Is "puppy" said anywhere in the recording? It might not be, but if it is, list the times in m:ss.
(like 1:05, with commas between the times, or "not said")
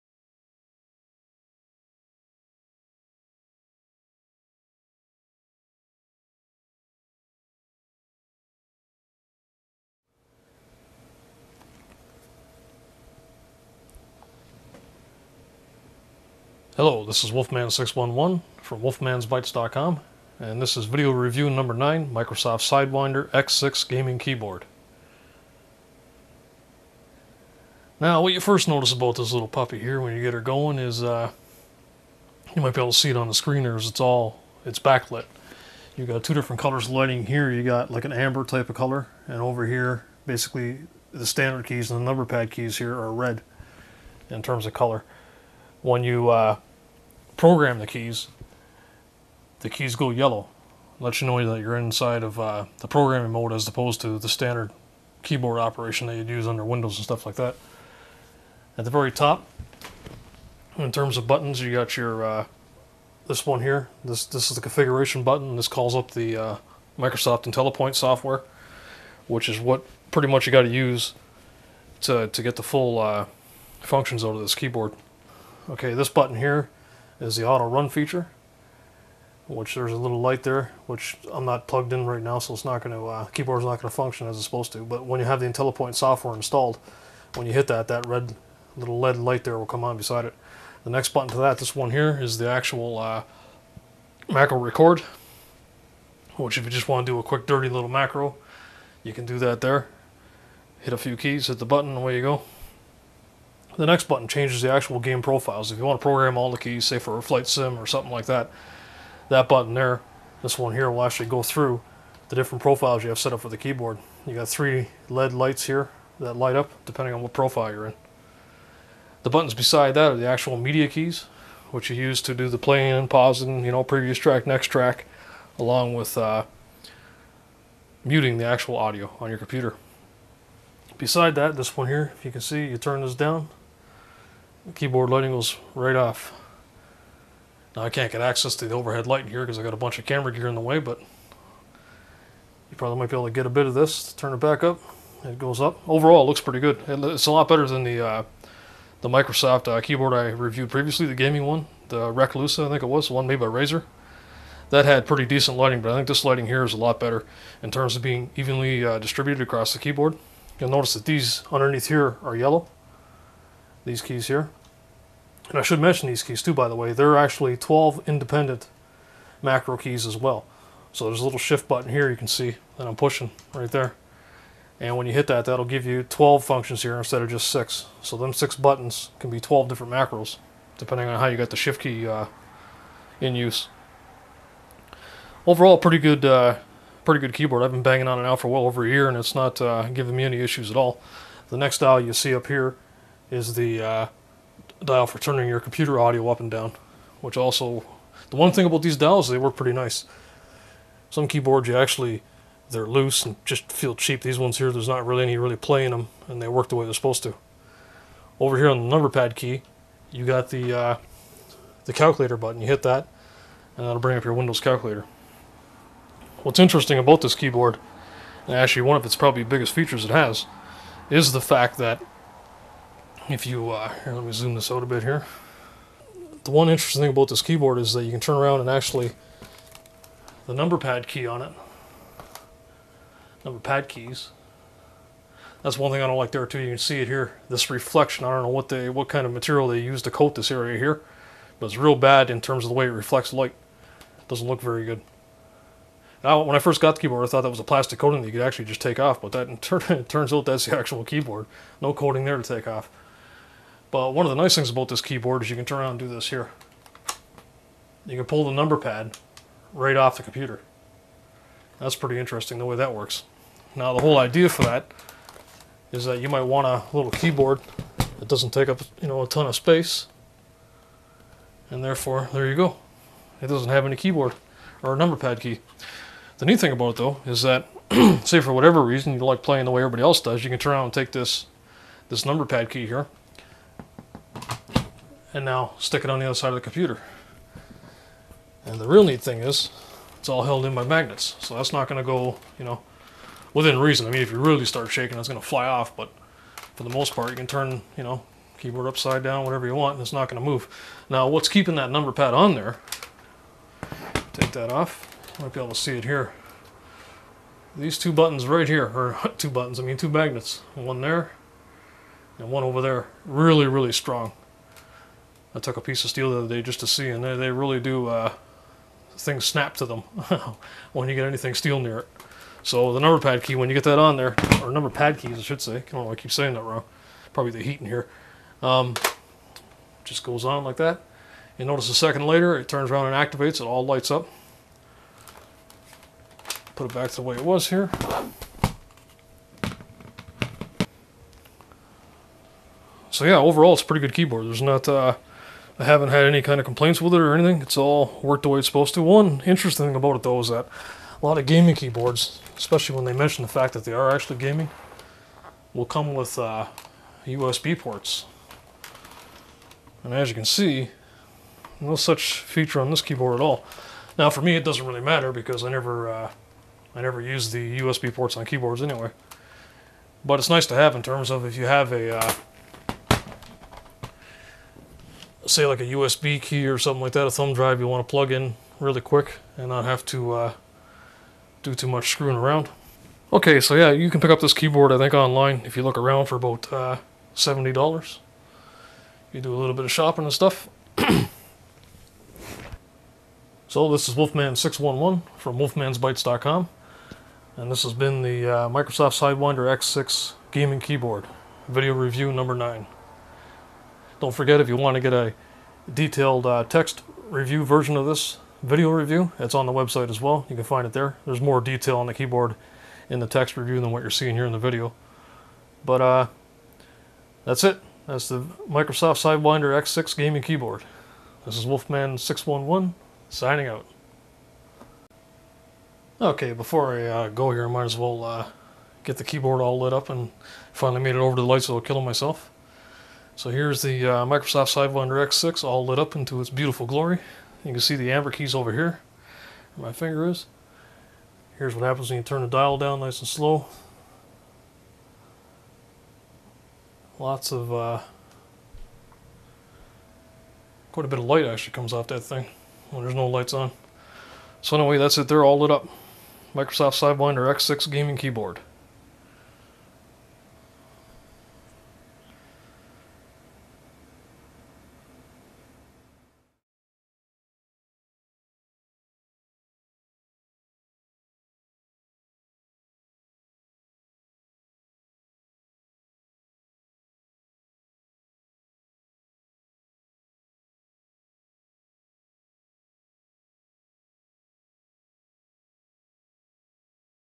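0:29.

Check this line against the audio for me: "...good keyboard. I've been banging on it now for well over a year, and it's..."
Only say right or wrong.
right.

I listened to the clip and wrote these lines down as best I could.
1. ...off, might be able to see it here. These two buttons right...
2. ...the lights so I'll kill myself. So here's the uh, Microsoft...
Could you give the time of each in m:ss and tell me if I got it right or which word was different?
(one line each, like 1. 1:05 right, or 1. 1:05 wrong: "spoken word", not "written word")
1. 5:04 right
2. 7:11 right.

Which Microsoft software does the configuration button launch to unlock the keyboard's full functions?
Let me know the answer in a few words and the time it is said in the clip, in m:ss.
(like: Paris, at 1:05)
Microsoft IntelliPoint, at 1:06.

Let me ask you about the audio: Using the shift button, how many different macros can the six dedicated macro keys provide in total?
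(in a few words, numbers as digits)
12.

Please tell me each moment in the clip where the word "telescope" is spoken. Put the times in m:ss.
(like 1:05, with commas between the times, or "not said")
not said.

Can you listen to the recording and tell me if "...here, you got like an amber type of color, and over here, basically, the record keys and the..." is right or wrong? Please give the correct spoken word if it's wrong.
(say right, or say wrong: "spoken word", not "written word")
wrong: "standard", not "record".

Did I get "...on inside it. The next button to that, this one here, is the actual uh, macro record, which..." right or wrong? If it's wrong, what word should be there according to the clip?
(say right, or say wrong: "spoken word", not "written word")
wrong: "beside", not "inside".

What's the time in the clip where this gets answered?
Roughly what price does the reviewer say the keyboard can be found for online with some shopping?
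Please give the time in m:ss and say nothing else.
6:27.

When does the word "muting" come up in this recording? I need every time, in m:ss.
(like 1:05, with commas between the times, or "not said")
2:08.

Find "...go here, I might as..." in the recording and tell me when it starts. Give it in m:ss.
7:07.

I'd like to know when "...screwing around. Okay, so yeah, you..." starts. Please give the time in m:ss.
6:22.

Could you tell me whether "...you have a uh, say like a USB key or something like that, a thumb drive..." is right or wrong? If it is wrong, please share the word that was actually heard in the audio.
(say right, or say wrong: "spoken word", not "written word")
right.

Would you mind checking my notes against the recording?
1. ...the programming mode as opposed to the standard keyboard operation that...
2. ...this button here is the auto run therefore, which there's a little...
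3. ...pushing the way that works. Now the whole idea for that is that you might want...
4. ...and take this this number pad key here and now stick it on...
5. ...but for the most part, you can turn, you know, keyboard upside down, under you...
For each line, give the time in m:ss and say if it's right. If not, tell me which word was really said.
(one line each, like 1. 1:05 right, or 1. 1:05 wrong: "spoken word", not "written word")
1. 0:52 right
2. 1:15 wrong: "feature", not "therefore"
3. 4:22 wrong: "interesting", not "pushing"
4. 4:40 right
5. 4:55 wrong: "whatever", not "under".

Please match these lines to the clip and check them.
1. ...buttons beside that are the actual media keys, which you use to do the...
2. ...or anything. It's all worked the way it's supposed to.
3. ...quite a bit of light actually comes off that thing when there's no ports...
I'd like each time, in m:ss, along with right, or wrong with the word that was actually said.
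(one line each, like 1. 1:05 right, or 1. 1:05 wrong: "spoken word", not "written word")
1. 1:59 right
2. 5:47 right
3. 7:30 wrong: "lights", not "ports".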